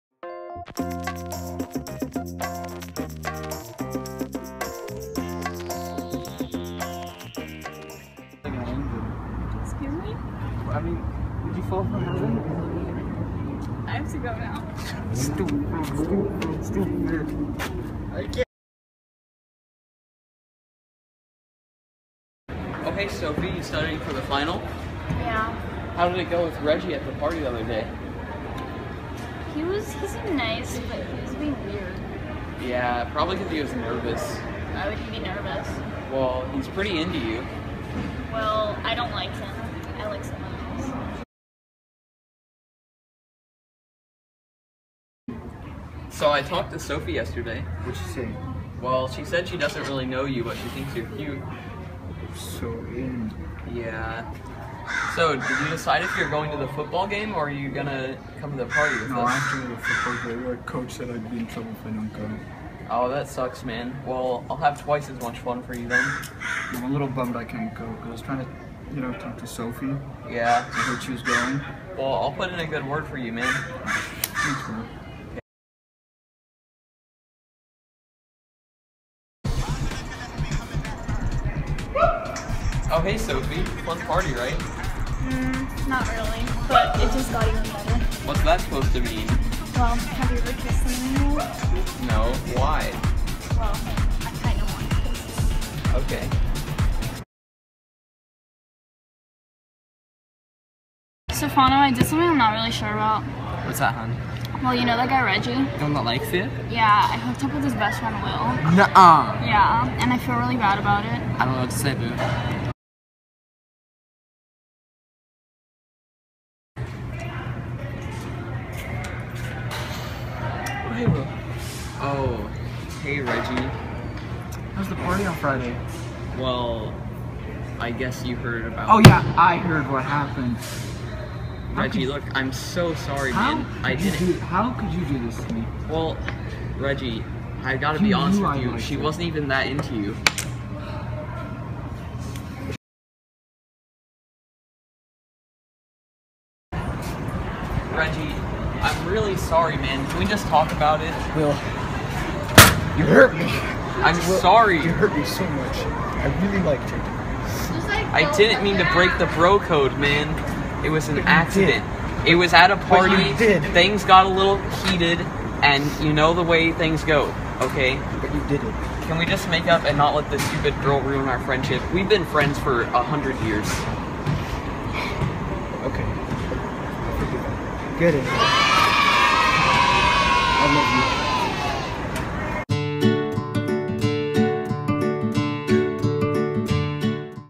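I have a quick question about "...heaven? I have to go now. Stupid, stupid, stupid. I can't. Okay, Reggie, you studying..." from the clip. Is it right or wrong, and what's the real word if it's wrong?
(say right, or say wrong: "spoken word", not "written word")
wrong: "Sophie", not "Reggie".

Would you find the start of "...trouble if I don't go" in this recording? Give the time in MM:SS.
01:01.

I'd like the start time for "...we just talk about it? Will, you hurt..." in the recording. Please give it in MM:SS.
02:30.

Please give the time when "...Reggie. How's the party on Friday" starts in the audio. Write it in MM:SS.
02:03.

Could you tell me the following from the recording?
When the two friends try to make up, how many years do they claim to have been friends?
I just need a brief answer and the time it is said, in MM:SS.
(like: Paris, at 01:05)
100, at 02:52.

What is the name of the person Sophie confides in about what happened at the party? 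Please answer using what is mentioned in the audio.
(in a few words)
Stefano.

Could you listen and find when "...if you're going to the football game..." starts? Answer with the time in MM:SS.
00:56.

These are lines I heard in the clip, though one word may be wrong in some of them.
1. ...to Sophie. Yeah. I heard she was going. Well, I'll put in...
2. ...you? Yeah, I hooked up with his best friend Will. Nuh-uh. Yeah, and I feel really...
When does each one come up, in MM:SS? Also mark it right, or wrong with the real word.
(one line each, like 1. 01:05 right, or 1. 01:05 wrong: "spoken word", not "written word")
1. 01:09 right
2. 01:46 right.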